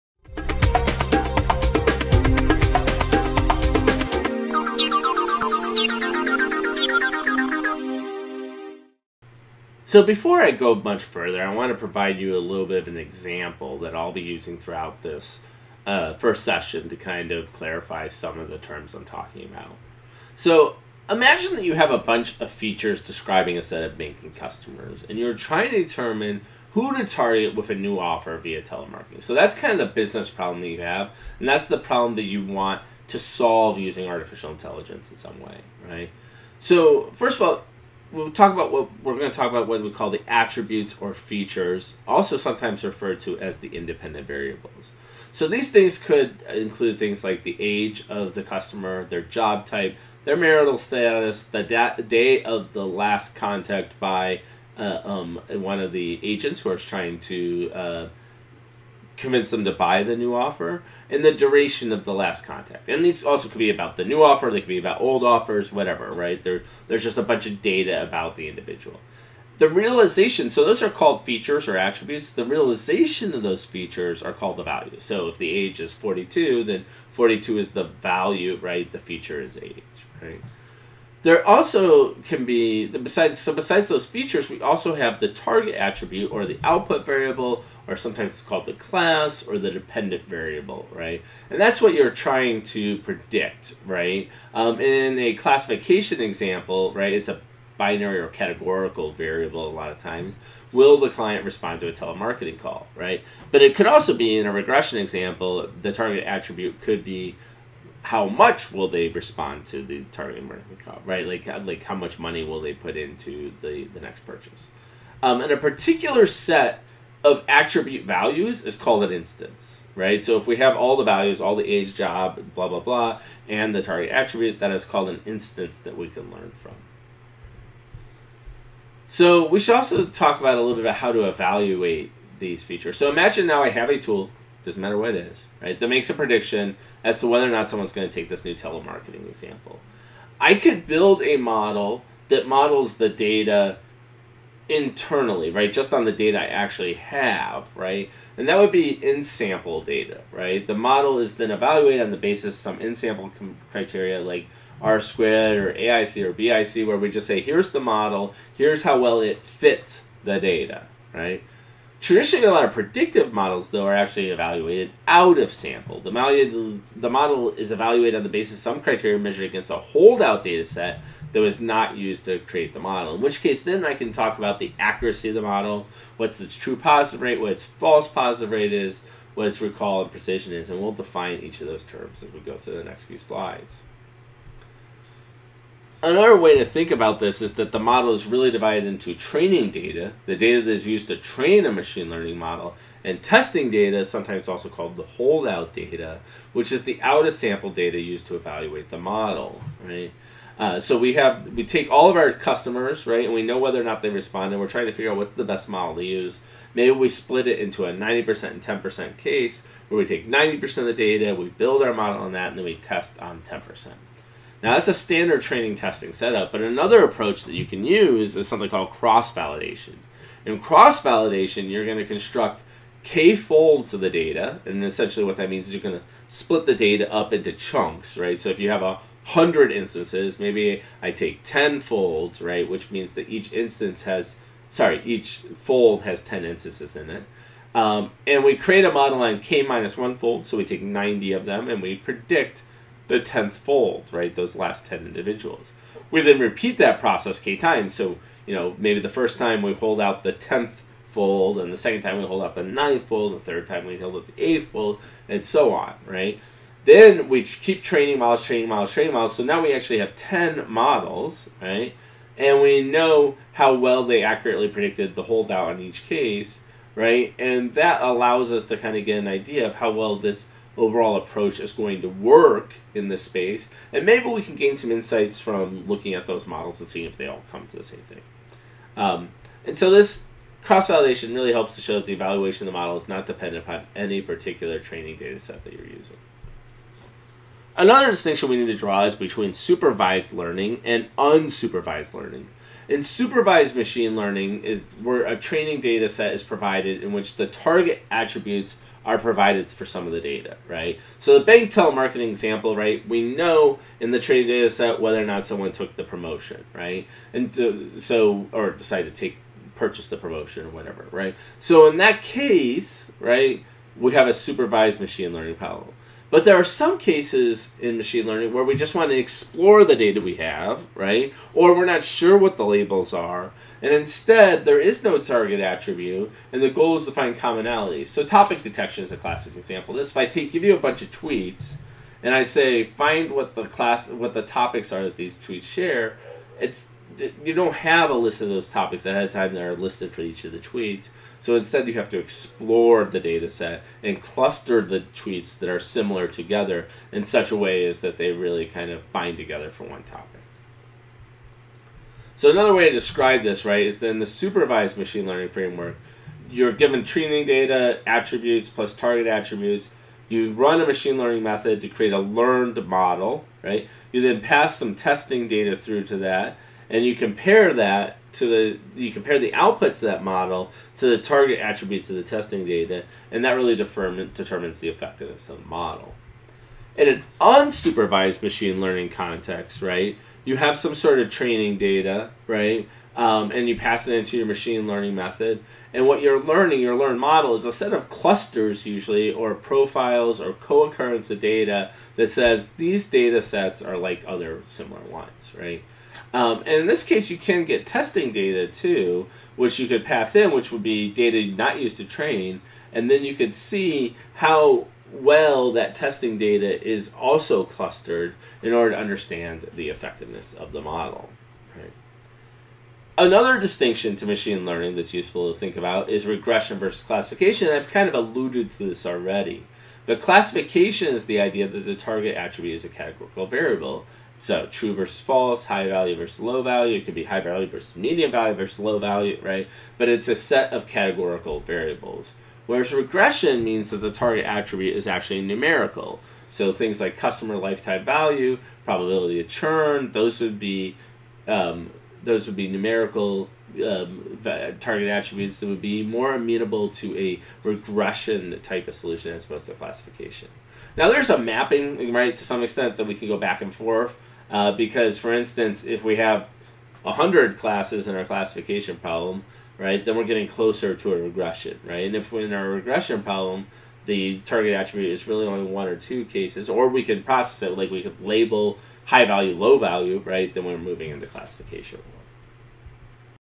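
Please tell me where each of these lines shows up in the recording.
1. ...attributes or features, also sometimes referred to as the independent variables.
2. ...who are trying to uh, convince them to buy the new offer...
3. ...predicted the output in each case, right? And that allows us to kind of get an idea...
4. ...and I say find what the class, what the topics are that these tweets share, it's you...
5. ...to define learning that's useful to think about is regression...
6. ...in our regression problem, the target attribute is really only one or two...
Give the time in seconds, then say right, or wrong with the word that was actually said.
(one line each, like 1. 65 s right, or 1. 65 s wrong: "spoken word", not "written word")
1. 40 s right
2. 56 s right
3. 264 s wrong: "holdout", not "output"
4. 332 s right
5. 414 s wrong: "machine", not "define"
6. 462 s right.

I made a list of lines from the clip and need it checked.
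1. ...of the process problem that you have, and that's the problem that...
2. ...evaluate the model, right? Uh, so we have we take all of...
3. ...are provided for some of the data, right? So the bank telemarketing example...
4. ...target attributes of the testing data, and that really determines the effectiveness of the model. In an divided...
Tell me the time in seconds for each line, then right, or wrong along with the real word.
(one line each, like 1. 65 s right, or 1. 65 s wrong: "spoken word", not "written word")
1. 29 s wrong: "business", not "process"
2. 198 s right
3. 299 s right
4. 371 s wrong: "unsupervised", not "divided".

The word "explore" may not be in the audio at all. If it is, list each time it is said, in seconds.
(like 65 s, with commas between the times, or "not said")
319 s, 342 s.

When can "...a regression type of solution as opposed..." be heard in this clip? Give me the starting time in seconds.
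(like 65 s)
447 s.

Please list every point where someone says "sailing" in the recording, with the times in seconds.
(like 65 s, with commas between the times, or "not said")
not said.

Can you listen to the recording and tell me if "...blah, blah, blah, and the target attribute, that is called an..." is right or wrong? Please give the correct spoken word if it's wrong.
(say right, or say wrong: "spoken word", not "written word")
right.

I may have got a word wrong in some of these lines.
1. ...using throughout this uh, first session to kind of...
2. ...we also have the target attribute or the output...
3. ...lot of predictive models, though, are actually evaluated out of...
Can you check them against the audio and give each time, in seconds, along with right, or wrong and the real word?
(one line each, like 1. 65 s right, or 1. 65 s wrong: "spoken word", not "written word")
1. 14 s right
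2. 84 s right
3. 162 s right.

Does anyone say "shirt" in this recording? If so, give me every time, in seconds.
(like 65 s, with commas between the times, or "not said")
not said.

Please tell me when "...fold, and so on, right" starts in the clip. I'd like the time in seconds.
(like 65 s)
254 s.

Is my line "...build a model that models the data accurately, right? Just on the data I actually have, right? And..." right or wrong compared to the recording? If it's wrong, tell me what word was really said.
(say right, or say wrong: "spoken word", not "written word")
wrong: "internally", not "accurately".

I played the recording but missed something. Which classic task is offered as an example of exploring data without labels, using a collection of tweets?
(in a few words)
topic detection.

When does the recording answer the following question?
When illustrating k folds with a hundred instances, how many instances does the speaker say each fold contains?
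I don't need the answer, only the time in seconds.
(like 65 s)
236 s.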